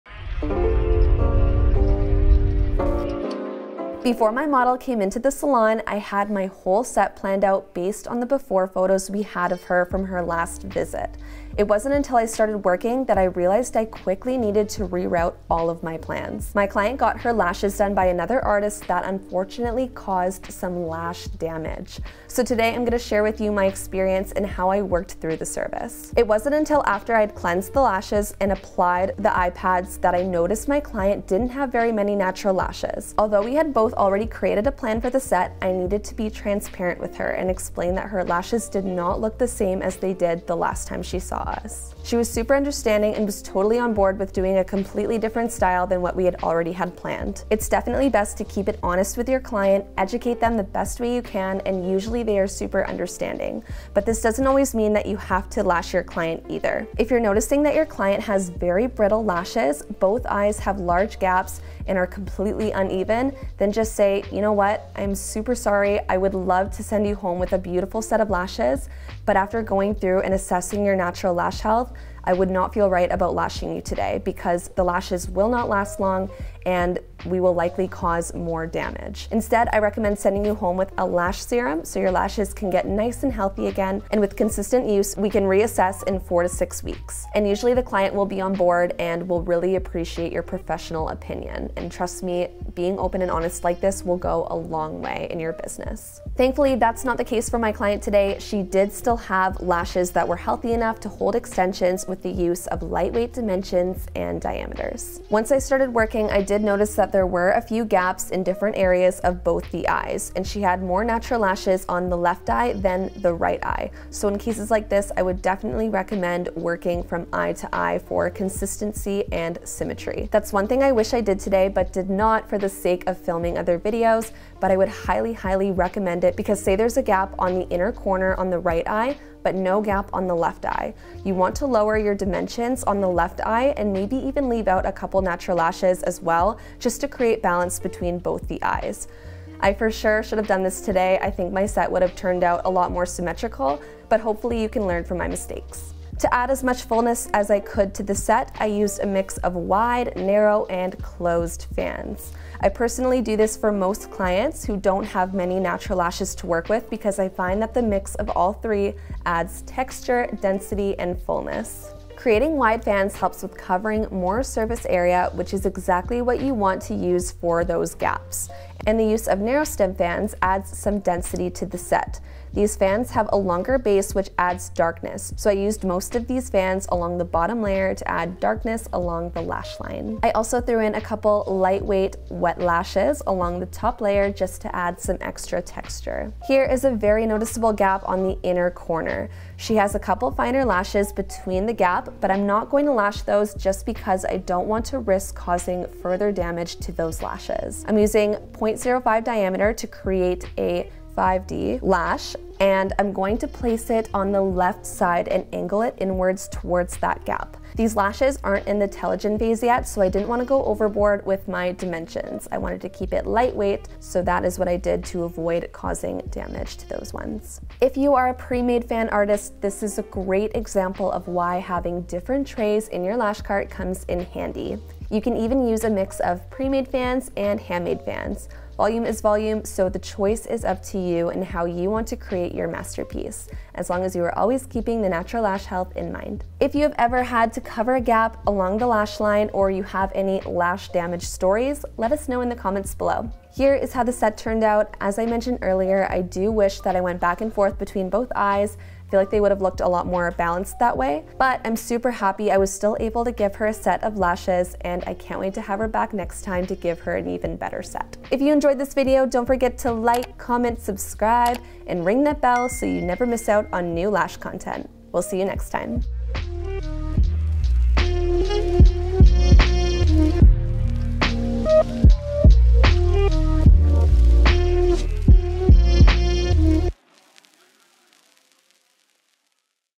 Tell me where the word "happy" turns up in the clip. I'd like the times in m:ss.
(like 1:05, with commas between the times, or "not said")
4:12.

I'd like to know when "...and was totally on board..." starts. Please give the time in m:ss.
0:43.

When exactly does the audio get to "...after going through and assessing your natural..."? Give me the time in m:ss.
1:09.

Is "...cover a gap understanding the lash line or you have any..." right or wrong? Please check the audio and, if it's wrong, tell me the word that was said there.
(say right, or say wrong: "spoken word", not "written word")
wrong: "along", not "understanding".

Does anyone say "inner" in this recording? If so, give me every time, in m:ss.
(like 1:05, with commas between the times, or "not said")
2:07, 3:08.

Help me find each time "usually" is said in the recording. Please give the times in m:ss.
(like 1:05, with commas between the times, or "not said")
0:51, 1:27.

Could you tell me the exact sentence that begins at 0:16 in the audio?
My client got her lashes done by another artist that unfortunately caused some lash damage.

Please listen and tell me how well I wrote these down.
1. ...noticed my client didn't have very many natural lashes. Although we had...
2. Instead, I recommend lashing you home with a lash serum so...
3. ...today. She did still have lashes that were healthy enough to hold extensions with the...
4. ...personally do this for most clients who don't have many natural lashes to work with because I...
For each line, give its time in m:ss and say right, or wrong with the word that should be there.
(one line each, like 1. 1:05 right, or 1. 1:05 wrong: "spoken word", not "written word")
1. 0:30 right
2. 1:19 wrong: "sending", not "lashing"
3. 1:38 right
4. 2:32 right.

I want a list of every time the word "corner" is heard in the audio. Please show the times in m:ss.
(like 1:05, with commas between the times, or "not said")
2:07, 3:08.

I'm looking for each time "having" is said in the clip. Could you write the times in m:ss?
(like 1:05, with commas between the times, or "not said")
3:41.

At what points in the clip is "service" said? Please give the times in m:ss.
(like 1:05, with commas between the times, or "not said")
0:25.